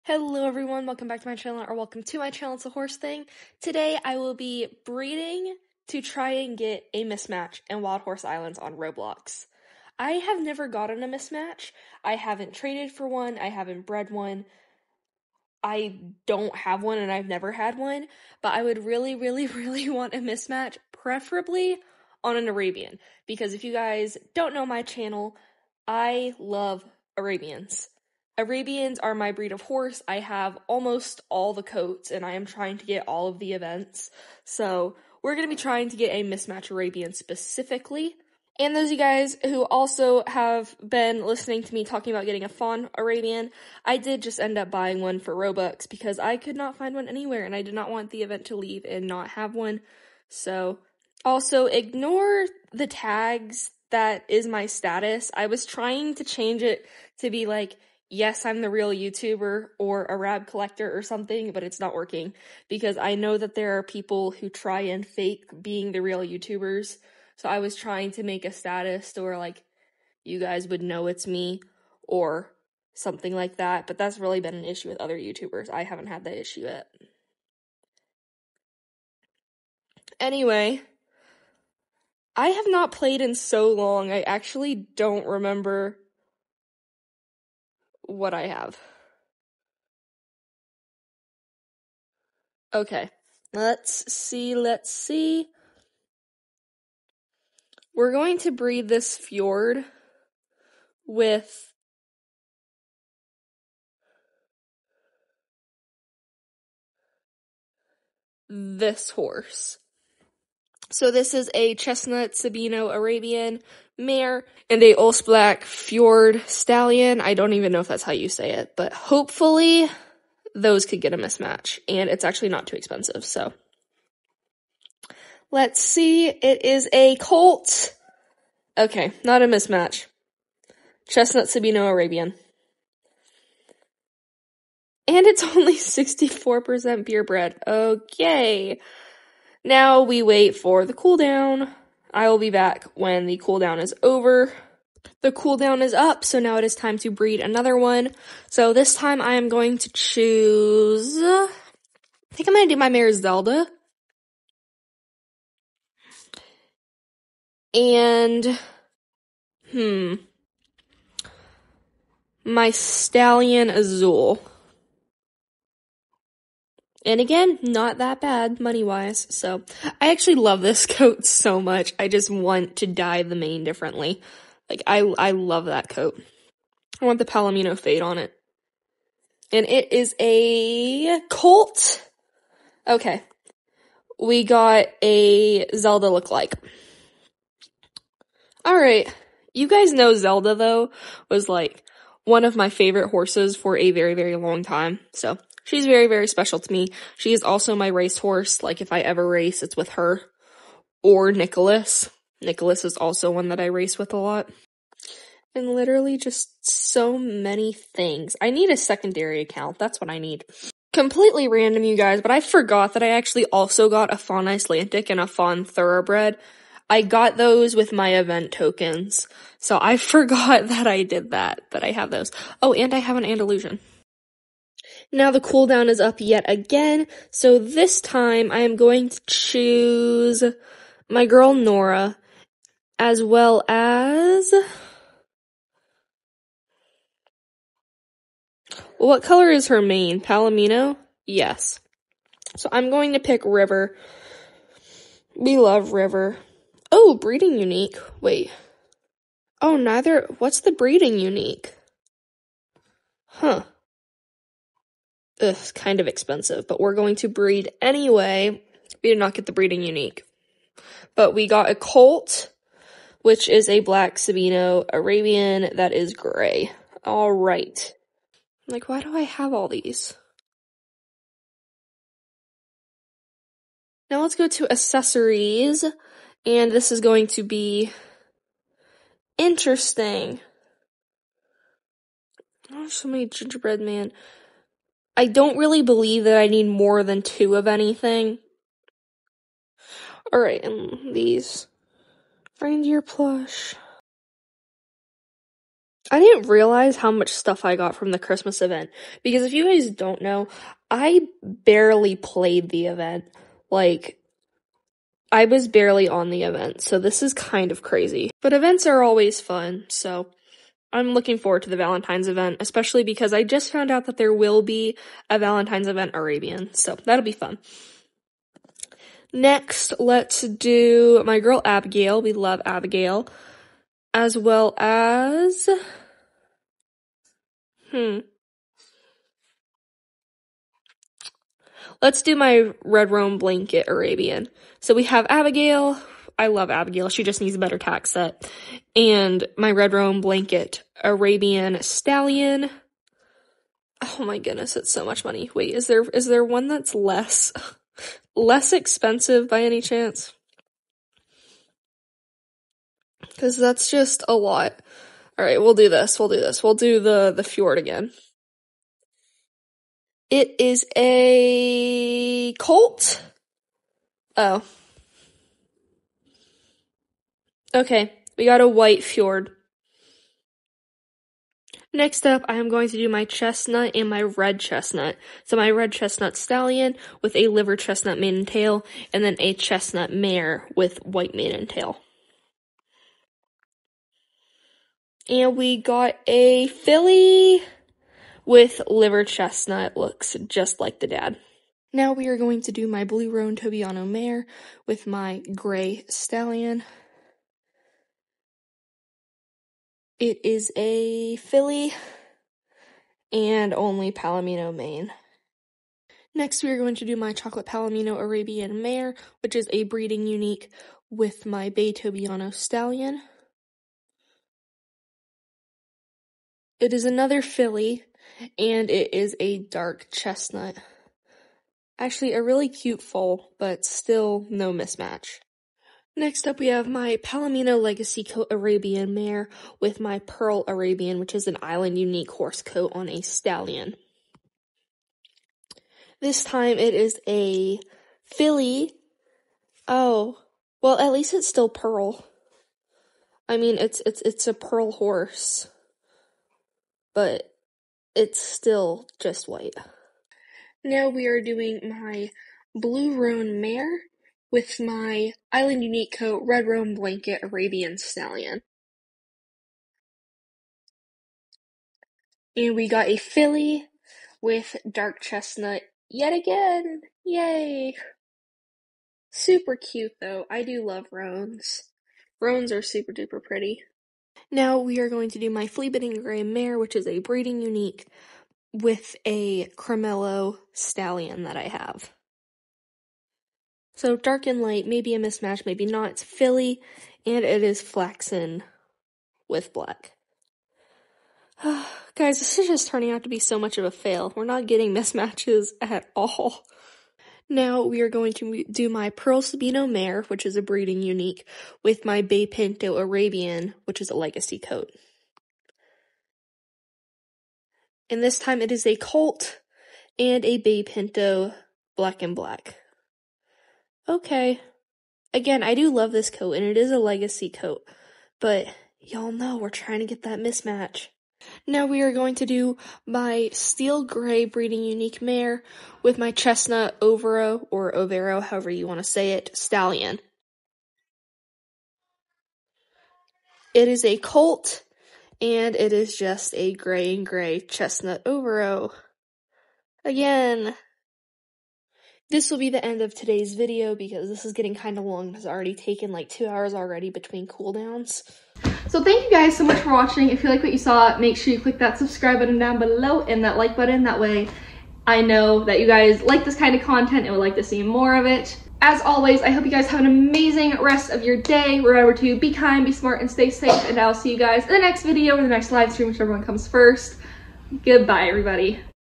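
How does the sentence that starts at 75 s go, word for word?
I haven't had that issue yet.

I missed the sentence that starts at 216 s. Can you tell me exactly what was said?
I got those with my event tokens.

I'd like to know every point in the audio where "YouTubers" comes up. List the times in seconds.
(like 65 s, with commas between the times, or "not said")
58 s, 66 s, 75 s.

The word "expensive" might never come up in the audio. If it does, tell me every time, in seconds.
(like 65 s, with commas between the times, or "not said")
122 s, 256 s, 348 s.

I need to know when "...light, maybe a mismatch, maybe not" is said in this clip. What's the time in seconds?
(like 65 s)
484 s.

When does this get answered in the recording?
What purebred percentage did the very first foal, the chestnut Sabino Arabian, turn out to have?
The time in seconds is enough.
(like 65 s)
135 s.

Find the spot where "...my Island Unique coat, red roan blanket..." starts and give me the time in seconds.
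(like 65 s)
454 s.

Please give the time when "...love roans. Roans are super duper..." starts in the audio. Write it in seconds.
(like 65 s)
470 s.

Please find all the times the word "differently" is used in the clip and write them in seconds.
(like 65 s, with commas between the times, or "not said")
173 s.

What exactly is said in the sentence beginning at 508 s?
And this time it is a colt and a Bay Pinto black and black.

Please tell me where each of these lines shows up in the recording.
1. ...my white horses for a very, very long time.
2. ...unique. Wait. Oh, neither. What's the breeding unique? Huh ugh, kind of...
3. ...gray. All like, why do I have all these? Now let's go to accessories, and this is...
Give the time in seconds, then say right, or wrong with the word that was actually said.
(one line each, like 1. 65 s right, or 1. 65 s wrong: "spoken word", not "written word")
1. 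192 s wrong: "favorite", not "white"
2. 247 s right
3. 266 s right.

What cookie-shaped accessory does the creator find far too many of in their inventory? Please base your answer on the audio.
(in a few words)
gingerbread man.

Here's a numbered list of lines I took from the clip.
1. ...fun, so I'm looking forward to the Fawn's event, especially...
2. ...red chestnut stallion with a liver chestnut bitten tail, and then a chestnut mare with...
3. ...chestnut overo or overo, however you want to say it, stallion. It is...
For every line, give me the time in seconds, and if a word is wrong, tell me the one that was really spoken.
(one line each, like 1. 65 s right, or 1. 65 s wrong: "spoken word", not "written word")
1. 309 s wrong: "Valentine", not "Fawn"
2. 375 s wrong: "maiden", not "bitten"
3. 526 s right.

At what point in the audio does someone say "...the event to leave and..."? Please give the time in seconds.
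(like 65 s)
48 s.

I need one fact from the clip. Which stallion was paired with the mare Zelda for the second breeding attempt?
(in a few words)
Azul.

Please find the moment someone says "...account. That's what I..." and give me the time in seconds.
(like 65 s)
209 s.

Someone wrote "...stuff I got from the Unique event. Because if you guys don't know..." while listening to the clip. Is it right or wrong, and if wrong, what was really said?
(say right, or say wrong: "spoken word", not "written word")
wrong: "Christmas", not "Unique".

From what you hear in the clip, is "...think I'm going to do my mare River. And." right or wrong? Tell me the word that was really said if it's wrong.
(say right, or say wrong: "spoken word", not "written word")
wrong: "Zelda", not "River".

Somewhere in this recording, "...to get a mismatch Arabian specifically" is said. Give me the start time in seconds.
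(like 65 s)
35 s.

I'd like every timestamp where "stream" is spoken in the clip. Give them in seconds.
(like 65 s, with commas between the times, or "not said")
565 s.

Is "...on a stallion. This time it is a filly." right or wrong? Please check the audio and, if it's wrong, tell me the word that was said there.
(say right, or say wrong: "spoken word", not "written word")
right.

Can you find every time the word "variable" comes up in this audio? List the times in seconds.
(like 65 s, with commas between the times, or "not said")
not said.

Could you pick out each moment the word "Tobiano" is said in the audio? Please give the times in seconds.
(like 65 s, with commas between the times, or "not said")
393 s, 411 s.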